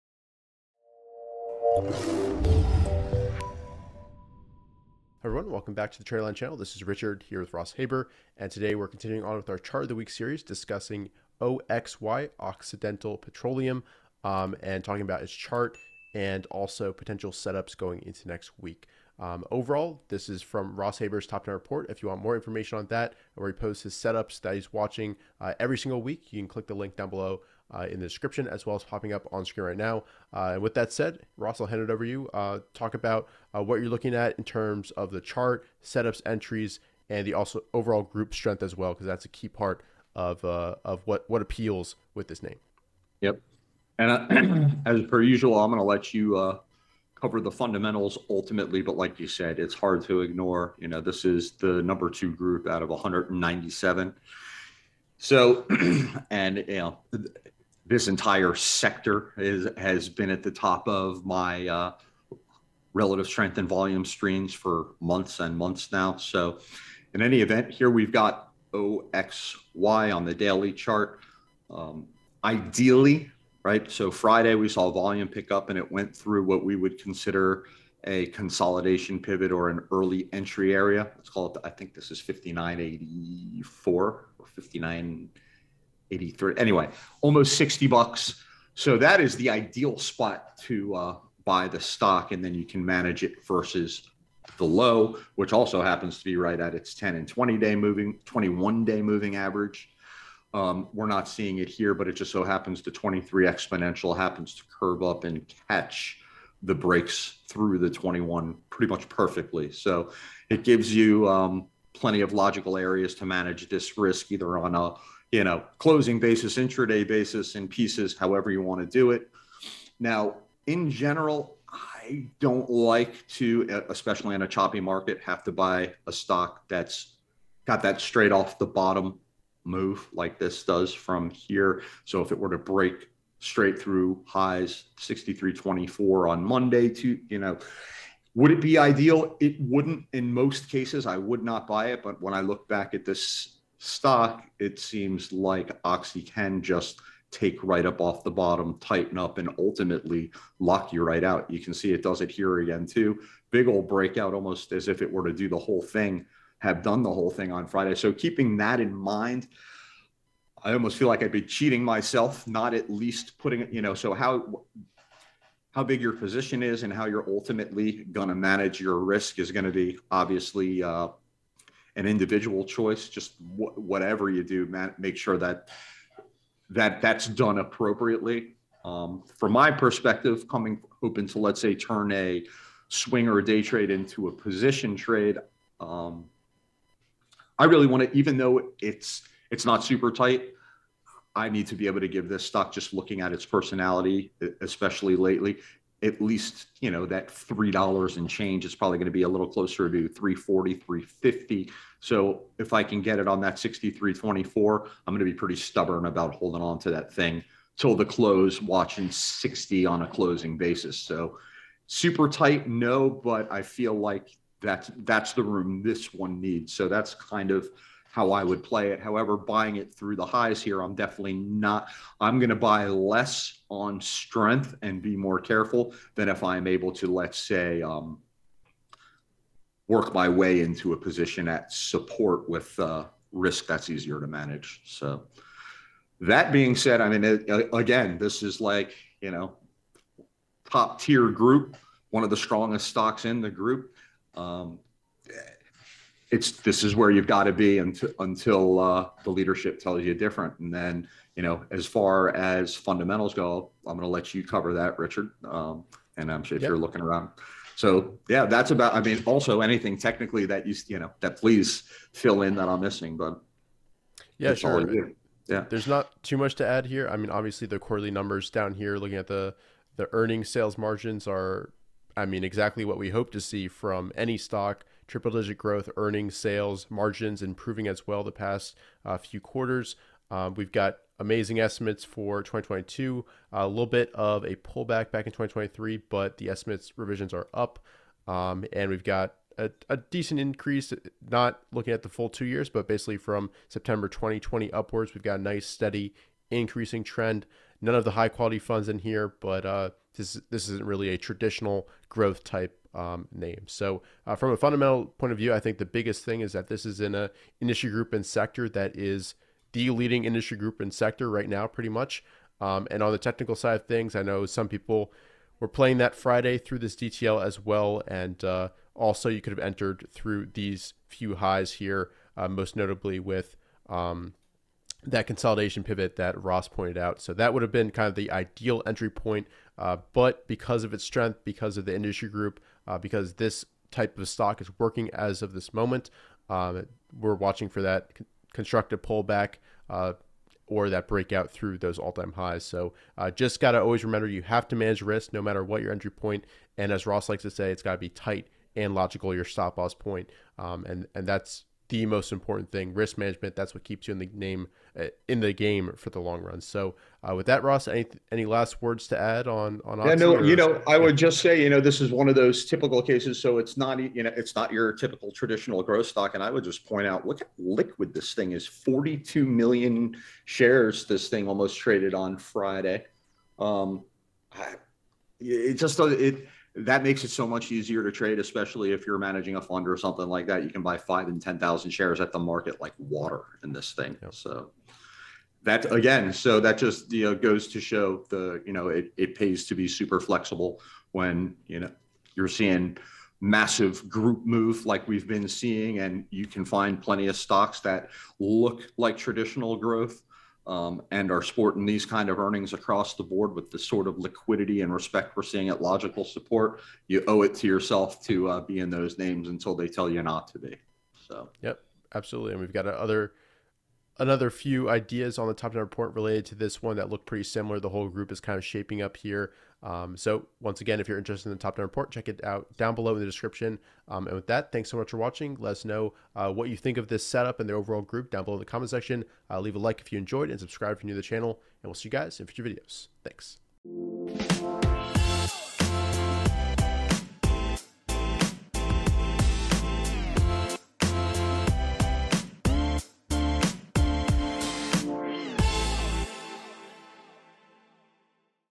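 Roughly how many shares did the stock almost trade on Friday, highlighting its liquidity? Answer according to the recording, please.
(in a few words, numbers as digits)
42 million.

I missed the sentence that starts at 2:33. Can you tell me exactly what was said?
Big old breakout, almost as if it were to do the whole thing, have done the whole thing on Friday.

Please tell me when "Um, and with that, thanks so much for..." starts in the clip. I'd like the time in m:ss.
7:04.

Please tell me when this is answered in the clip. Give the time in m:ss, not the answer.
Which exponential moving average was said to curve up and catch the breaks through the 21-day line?
1:42.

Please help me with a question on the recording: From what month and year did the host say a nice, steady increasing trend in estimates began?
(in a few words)
September 2020.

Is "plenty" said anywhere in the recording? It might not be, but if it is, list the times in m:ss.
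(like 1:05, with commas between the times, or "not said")
1:51, 6:37.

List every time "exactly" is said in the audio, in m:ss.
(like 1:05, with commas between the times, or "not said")
4:32.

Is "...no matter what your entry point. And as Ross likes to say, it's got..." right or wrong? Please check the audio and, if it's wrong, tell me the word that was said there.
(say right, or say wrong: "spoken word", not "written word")
right.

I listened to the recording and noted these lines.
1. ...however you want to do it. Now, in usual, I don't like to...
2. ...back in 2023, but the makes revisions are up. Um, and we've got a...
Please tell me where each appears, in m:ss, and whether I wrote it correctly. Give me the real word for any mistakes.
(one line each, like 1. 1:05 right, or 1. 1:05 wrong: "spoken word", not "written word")
1. 1:58 wrong: "general", not "usual"
2. 4:45 wrong: "estimates", not "makes".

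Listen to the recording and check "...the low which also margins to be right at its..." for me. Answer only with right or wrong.
wrong.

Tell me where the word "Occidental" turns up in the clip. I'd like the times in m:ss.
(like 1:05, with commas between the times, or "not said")
0:12.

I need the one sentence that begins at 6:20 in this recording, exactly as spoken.
You can buy five and 10,000 shares at the market like water in this thing.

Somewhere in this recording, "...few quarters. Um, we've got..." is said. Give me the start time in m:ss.
4:39.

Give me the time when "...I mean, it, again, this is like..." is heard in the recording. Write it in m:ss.
3:56.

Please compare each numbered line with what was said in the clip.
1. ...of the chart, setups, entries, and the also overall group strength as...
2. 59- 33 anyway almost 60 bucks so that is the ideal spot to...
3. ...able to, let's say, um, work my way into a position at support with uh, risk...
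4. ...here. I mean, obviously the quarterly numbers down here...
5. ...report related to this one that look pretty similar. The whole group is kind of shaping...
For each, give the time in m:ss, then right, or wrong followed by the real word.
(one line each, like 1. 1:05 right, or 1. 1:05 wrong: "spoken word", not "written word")
1. 0:34 right
2. 1:25 wrong: "83", not "33"
3. 3:46 right
4. 4:26 right
5. 6:55 right.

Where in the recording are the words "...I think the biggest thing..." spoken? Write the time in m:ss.
5:05.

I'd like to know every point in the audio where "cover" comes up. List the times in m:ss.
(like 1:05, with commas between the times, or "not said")
0:47, 4:14.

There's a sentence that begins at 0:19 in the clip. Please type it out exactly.
Um, overall, this is from Ross Haber's Top 10 Report.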